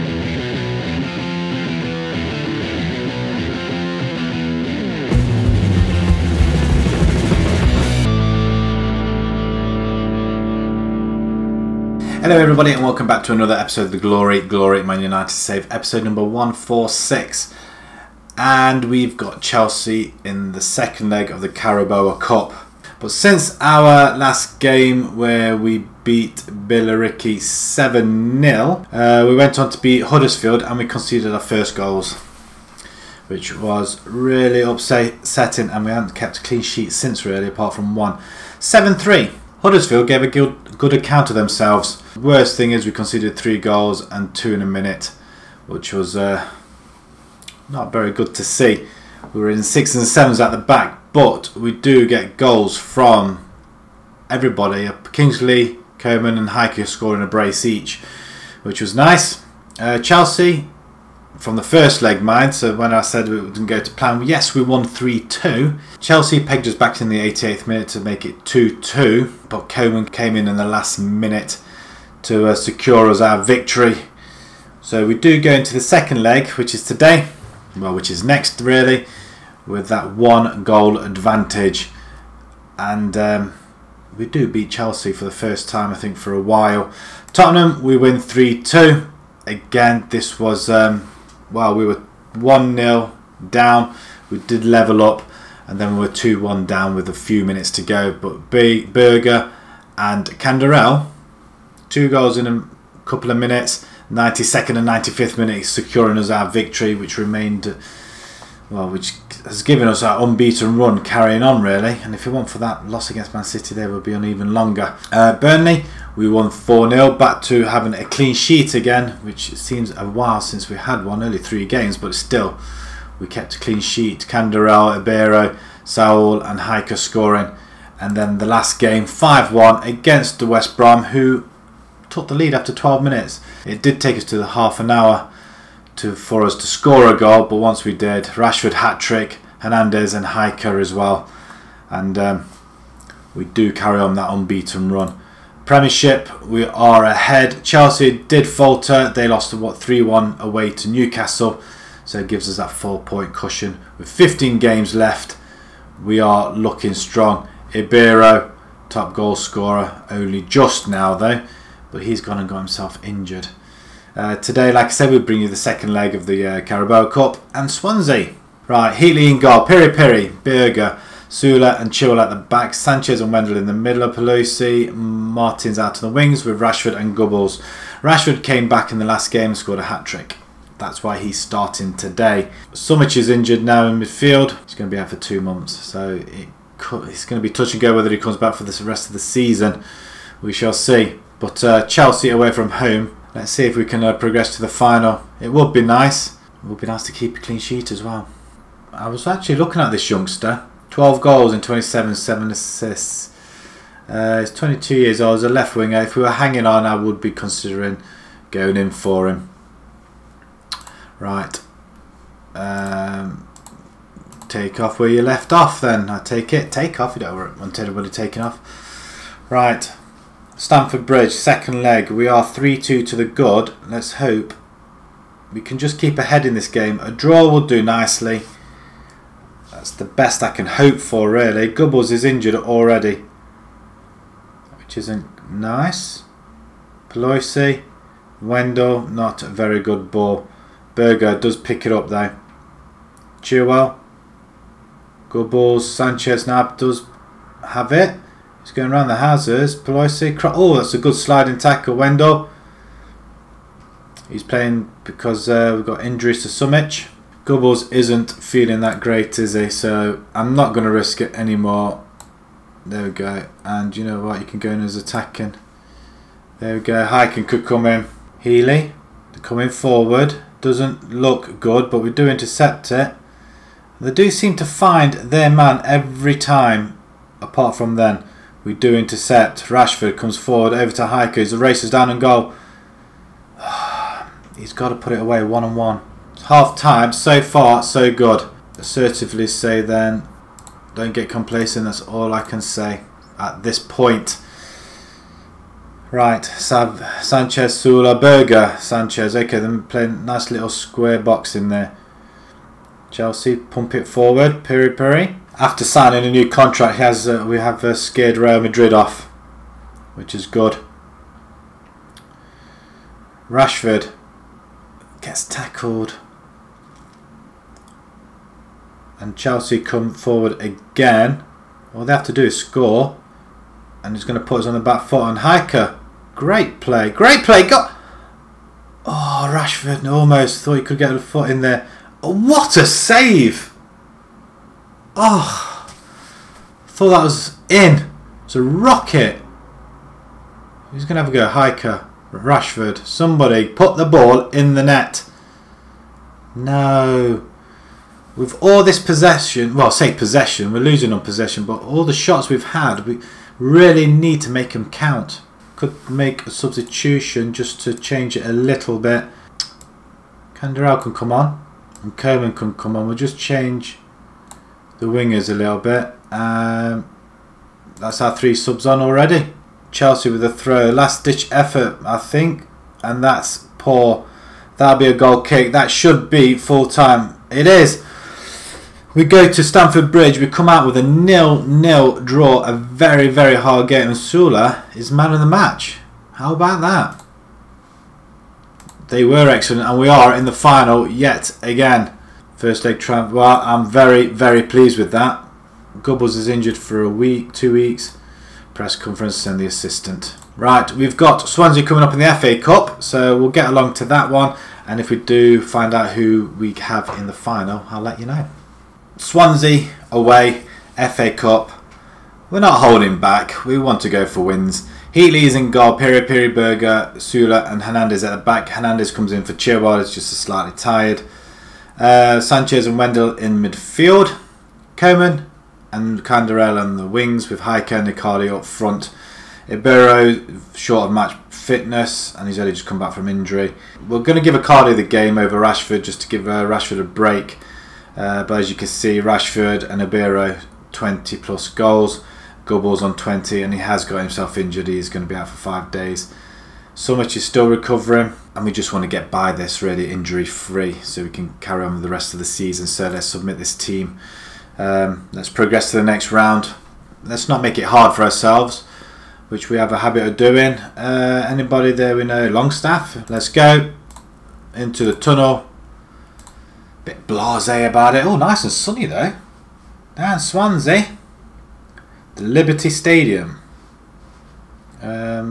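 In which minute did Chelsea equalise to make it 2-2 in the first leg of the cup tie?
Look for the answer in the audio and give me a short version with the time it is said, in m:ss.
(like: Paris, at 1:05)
88th, at 1:07.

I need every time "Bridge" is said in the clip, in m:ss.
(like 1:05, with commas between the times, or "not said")
3:41, 6:20.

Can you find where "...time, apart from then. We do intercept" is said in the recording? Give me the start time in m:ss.
4:36.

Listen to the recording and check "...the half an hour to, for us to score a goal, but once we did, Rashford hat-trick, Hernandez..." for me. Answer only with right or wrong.
right.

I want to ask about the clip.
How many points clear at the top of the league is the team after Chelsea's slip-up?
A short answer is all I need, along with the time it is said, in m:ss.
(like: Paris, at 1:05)
4, at 2:32.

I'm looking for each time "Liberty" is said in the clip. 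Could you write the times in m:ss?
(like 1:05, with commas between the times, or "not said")
7:52.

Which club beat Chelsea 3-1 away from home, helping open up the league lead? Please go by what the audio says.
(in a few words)
Newcastle.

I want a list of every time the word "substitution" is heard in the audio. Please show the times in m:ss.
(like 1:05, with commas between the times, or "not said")
5:56.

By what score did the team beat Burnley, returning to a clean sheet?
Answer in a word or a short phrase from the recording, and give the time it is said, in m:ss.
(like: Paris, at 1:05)
4-0, at 1:56.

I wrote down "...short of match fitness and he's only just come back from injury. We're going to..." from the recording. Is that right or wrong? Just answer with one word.
right.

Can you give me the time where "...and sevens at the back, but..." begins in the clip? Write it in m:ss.
0:49.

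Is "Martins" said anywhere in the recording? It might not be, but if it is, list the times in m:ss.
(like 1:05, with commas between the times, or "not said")
2:54.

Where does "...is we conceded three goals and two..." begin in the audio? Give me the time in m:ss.
0:42.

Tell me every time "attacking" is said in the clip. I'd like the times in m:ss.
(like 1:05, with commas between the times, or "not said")
4:24.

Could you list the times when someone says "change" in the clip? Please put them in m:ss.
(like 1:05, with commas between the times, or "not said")
5:57, 6:03.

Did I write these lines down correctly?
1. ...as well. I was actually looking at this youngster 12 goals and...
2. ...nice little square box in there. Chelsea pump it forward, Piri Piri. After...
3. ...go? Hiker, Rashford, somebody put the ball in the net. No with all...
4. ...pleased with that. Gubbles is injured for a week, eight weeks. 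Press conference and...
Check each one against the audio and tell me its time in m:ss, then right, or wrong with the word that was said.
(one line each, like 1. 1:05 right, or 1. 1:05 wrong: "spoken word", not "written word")
1. 3:17 right
2. 5:00 right
3. 5:41 right
4. 6:34 wrong: "two", not "eight".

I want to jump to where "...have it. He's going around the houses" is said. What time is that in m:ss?
4:07.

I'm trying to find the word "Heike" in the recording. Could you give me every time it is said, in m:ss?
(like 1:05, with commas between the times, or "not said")
0:56, 7:07.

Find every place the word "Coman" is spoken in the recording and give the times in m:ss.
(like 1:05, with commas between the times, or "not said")
0:55, 1:09, 6:02, 7:04.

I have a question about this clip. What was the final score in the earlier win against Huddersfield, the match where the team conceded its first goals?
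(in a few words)
7-3.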